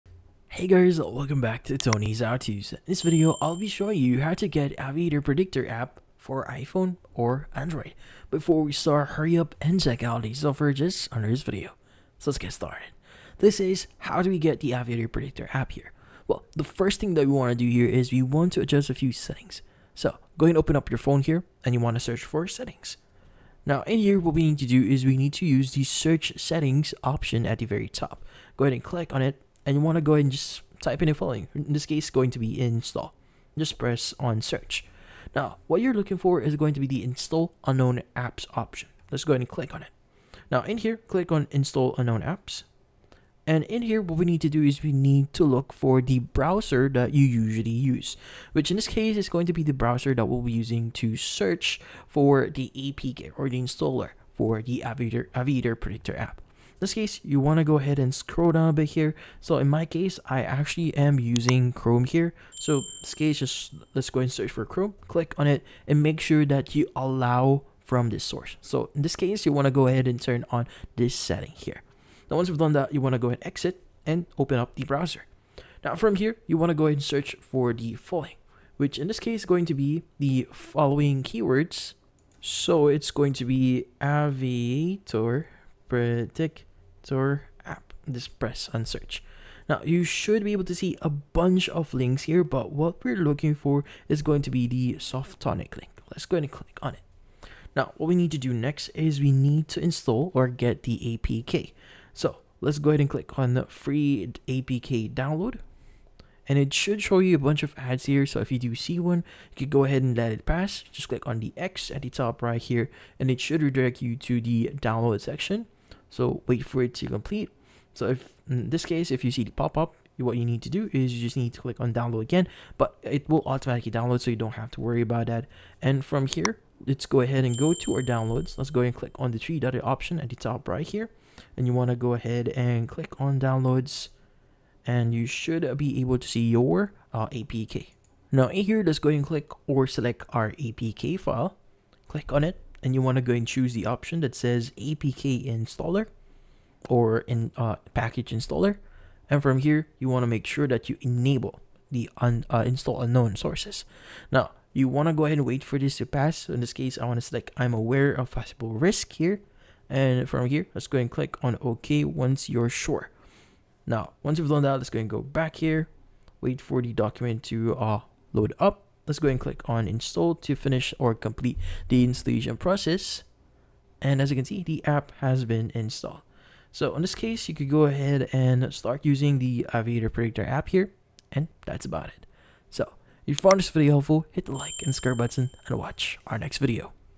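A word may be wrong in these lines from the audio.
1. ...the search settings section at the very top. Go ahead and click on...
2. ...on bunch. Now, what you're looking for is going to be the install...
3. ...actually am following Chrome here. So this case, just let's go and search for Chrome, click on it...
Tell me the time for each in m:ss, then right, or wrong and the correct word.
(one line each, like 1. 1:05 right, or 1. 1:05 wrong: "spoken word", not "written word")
1. 0:25 wrong: "option", not "section"
2. 0:34 wrong: "search", not "bunch"
3. 1:00 wrong: "using", not "following".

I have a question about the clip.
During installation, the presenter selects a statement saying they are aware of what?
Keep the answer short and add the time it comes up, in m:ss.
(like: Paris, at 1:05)
possible risk, at 2:38.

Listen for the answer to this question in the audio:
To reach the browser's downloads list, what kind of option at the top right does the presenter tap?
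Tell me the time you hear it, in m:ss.
2:09.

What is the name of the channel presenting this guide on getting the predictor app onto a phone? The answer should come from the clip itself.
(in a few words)
Tony's HowTos.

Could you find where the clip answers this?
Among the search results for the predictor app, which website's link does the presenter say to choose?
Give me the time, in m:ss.
1:34.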